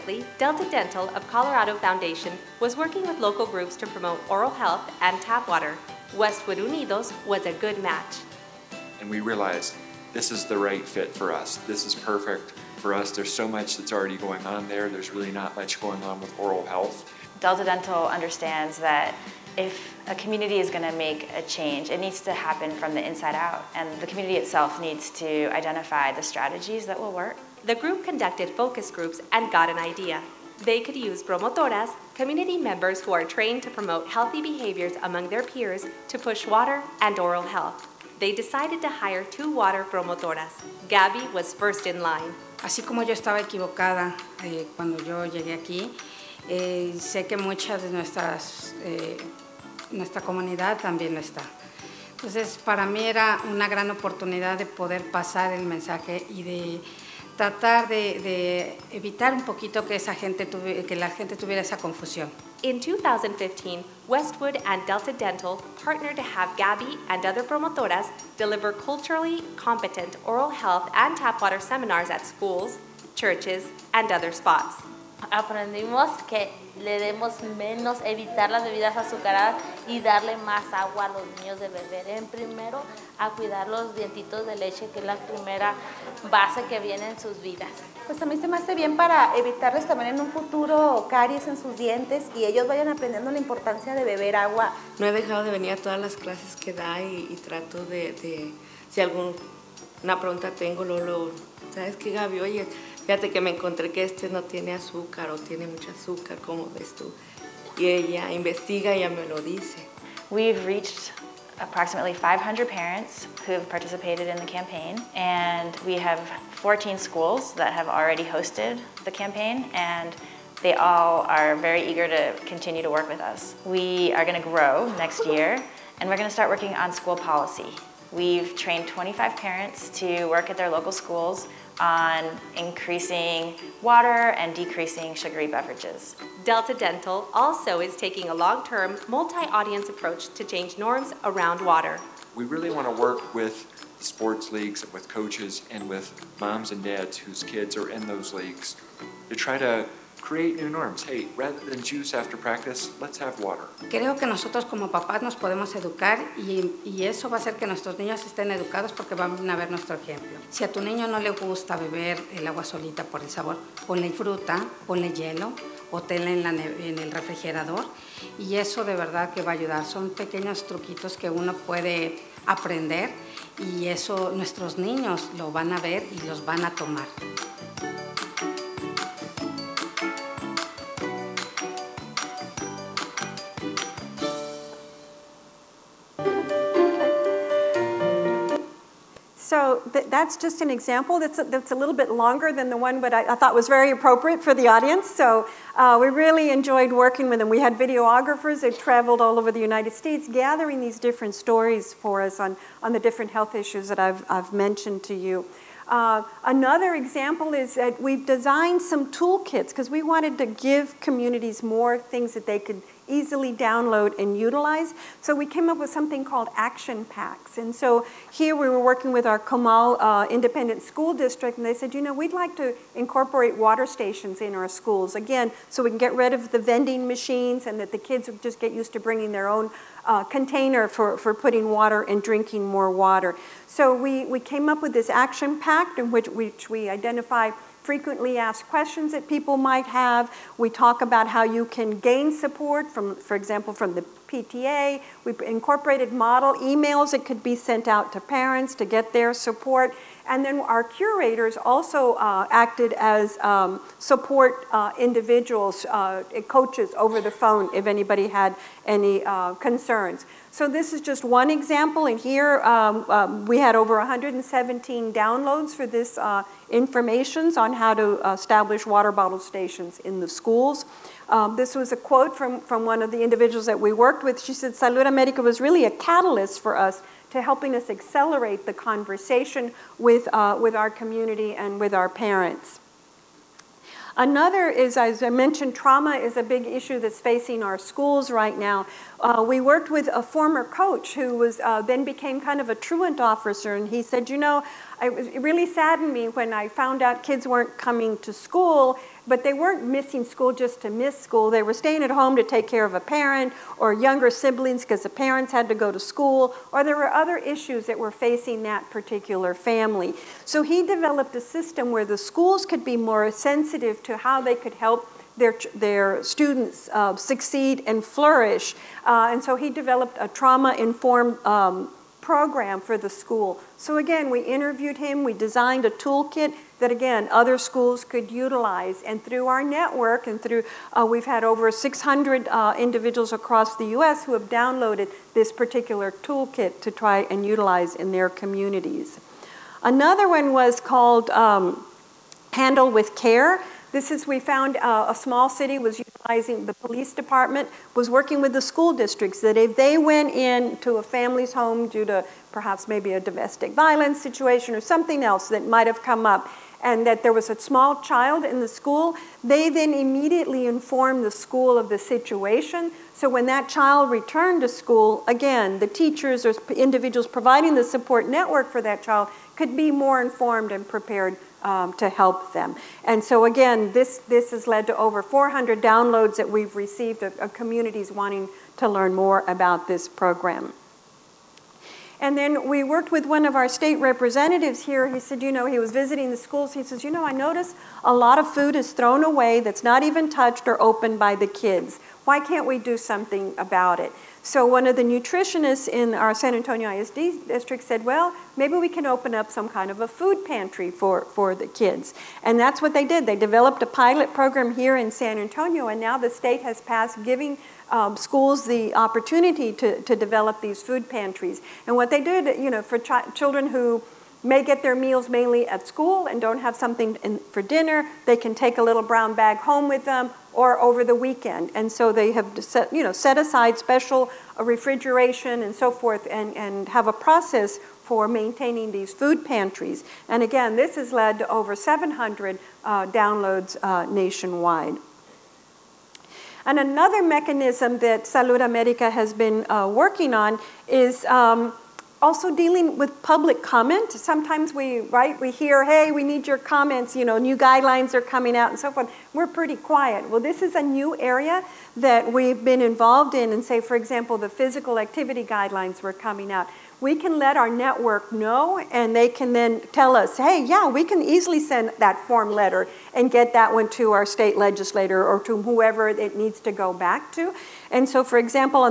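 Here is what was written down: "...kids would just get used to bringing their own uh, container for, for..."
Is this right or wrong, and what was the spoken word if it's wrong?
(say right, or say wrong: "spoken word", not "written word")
right.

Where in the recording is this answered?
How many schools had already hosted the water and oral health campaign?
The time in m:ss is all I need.
1:56.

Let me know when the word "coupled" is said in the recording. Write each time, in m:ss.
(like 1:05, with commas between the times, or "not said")
not said.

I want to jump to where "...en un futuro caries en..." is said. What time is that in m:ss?
1:30.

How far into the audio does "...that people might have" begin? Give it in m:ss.
3:59.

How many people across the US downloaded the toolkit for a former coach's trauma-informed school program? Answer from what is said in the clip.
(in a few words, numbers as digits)
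600.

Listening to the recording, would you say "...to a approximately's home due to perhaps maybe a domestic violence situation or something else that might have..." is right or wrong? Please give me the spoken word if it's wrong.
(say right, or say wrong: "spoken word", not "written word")
wrong: "family", not "approximately".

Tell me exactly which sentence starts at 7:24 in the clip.
Sometimes we, right, we hear, hey, we need your comments, you know, new guidelines are coming out and so forth.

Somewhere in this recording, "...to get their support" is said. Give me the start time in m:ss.
4:08.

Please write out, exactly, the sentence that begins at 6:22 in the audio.
And then we worked with one of our state representatives here.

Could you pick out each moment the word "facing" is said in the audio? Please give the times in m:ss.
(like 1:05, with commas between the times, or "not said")
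4:47, 5:08.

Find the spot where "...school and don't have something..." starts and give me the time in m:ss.
6:55.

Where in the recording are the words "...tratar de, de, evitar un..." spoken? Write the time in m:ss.
0:57.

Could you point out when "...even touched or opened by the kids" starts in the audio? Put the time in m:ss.
6:30.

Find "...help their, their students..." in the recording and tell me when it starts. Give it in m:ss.
5:14.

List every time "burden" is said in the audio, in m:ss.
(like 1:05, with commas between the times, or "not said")
not said.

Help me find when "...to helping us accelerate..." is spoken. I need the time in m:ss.
4:37.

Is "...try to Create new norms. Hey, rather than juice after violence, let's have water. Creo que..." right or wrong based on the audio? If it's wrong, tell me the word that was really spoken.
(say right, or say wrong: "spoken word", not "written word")
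wrong: "practice", not "violence".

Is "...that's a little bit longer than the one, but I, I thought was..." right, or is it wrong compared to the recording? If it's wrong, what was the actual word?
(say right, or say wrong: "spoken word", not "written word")
right.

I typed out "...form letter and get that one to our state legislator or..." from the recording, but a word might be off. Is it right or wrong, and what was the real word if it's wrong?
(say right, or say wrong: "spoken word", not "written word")
right.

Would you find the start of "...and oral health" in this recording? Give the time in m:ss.
0:37.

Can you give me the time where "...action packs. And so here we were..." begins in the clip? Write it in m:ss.
3:36.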